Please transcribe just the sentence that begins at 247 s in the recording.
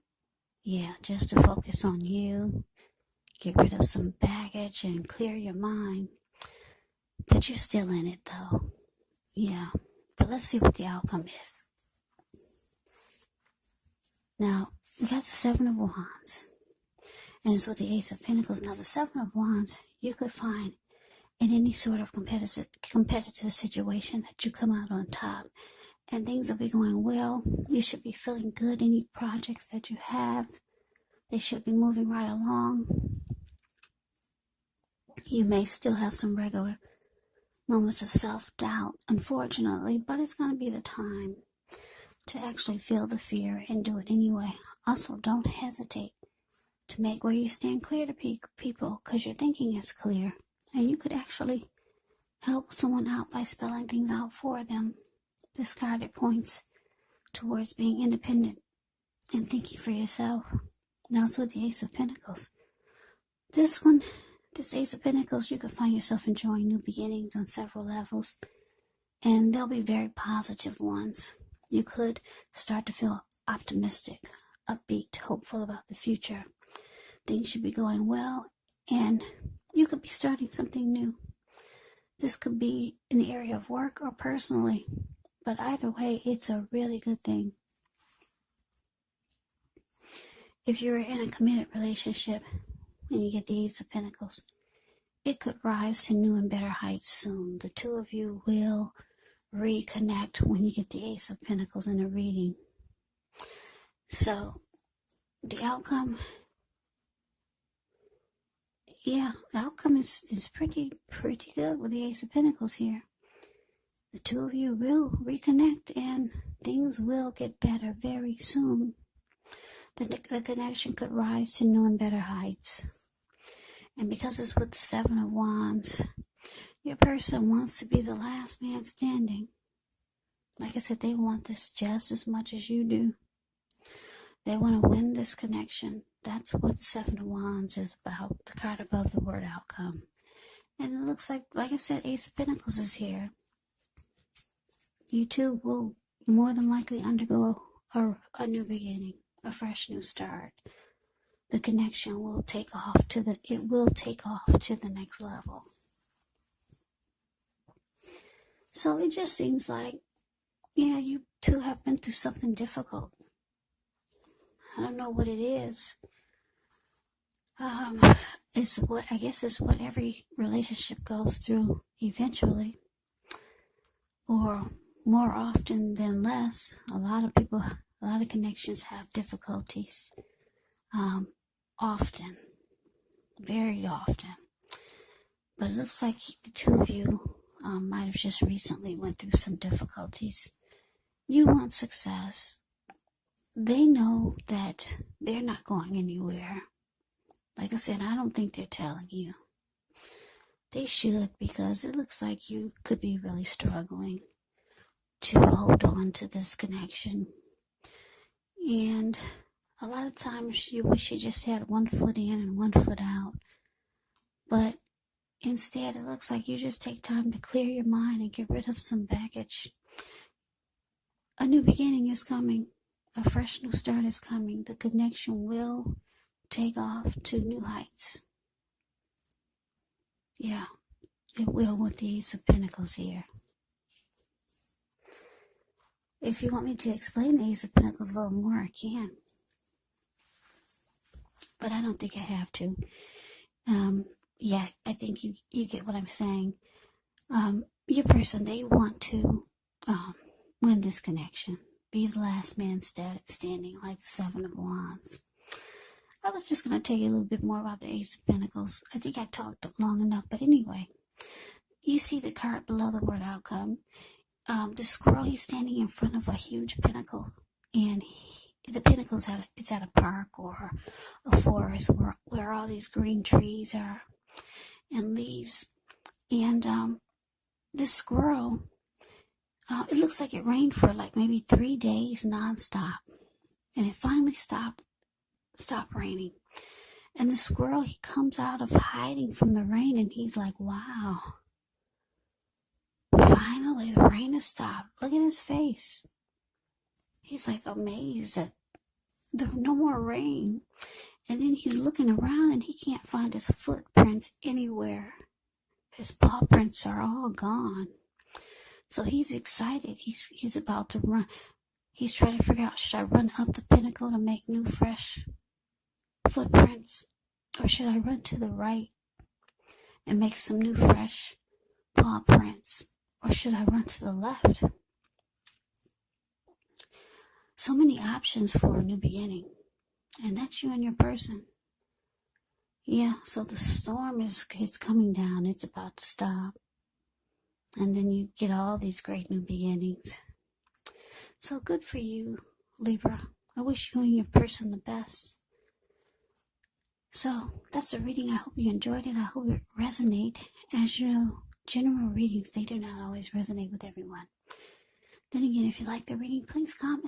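Um, your person, they want to um, win this connection, be the last man standing, like the Seven of Wands.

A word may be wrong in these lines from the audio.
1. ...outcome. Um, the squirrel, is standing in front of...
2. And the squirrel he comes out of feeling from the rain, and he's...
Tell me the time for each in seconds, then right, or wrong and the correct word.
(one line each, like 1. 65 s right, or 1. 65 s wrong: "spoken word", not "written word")
1. 263 s right
2. 287 s wrong: "hiding", not "feeling".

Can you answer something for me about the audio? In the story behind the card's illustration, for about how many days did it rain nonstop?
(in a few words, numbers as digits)
3.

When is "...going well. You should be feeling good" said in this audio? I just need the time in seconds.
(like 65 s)
26 s.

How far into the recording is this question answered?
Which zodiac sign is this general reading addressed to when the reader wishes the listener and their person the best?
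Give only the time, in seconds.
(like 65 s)
342 s.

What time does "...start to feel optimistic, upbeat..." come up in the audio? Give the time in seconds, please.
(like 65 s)
72 s.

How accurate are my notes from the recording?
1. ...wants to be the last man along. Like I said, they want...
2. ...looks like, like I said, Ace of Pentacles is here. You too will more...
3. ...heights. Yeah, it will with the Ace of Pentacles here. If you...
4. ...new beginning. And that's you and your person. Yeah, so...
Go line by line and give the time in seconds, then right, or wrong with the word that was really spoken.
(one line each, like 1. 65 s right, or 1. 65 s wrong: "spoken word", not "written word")
1. 127 s wrong: "standing", not "along"
2. 141 s right
3. 227 s right
4. 328 s right.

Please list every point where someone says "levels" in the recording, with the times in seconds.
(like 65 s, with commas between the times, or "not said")
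67 s, 155 s.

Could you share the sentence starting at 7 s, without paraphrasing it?
But you're still in it though.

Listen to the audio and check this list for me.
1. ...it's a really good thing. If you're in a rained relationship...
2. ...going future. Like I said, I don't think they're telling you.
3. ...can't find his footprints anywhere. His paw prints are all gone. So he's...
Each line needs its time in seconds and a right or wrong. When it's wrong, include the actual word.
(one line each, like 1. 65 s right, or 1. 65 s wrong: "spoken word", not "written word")
1. 86 s wrong: "committed", not "rained"
2. 195 s wrong: "anywhere", not "future"
3. 302 s right.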